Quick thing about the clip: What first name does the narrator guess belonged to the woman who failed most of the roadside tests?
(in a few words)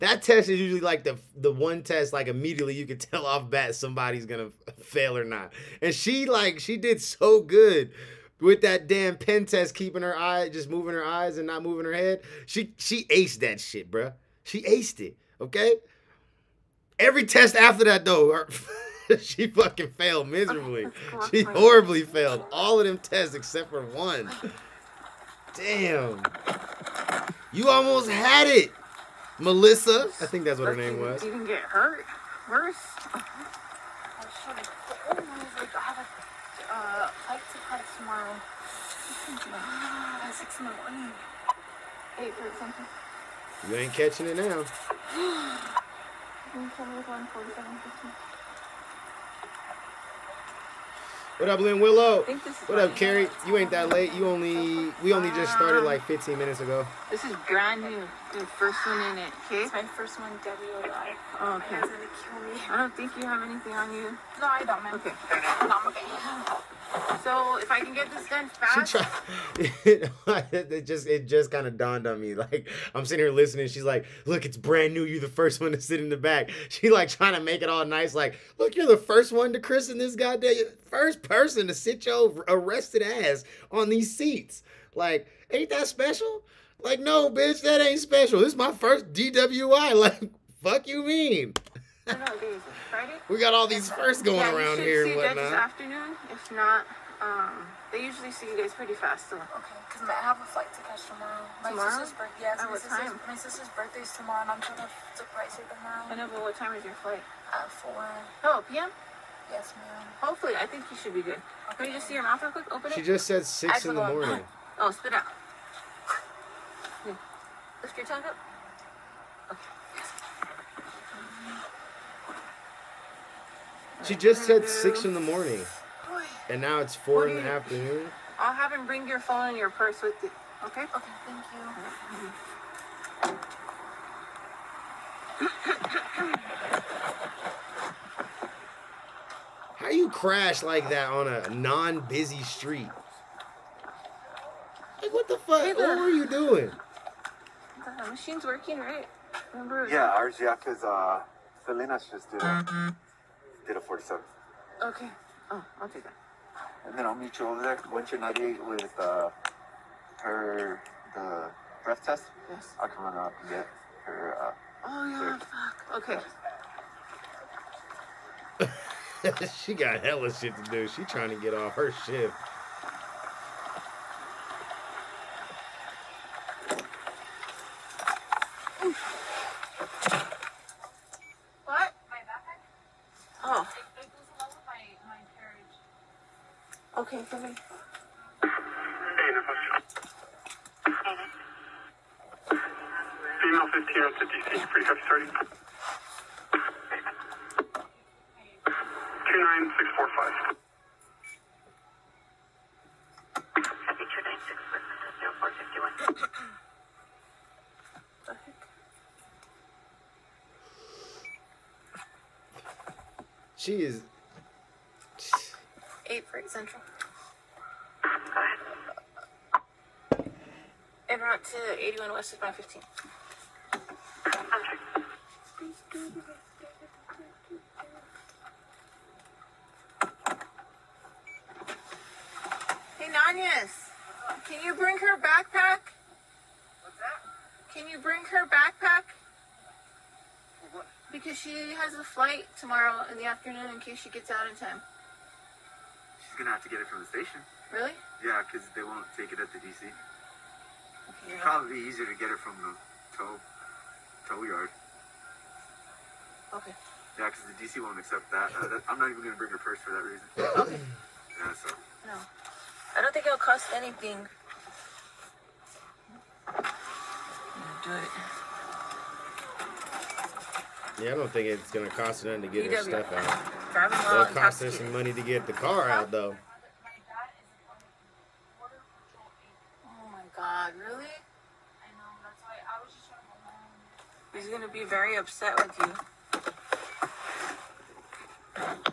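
Melissa.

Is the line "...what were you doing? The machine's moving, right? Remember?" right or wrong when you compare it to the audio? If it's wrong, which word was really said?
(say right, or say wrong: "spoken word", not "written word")
wrong: "working", not "moving".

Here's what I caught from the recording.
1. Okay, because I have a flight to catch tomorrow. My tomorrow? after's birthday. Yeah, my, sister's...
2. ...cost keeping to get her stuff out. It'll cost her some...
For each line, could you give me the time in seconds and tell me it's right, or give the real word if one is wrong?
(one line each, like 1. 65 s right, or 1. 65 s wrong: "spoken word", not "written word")
1. 99 s wrong: "sister", not "after"
2. 271 s wrong: "anything", not "keeping".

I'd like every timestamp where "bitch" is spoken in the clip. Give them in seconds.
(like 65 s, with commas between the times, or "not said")
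87 s.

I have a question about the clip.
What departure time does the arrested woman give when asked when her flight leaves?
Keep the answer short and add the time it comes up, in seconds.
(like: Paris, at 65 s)
4, at 107 s.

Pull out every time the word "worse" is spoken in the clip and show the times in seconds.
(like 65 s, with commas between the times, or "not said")
32 s.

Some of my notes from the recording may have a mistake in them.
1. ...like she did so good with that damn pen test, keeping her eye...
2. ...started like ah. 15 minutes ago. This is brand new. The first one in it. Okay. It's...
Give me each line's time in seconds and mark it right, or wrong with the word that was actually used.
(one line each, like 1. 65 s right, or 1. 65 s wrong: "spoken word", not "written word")
1. 6 s right
2. 55 s right.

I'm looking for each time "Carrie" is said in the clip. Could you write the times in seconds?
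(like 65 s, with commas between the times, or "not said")
52 s.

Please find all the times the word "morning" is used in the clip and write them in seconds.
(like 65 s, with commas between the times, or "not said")
40 s, 114 s, 125 s.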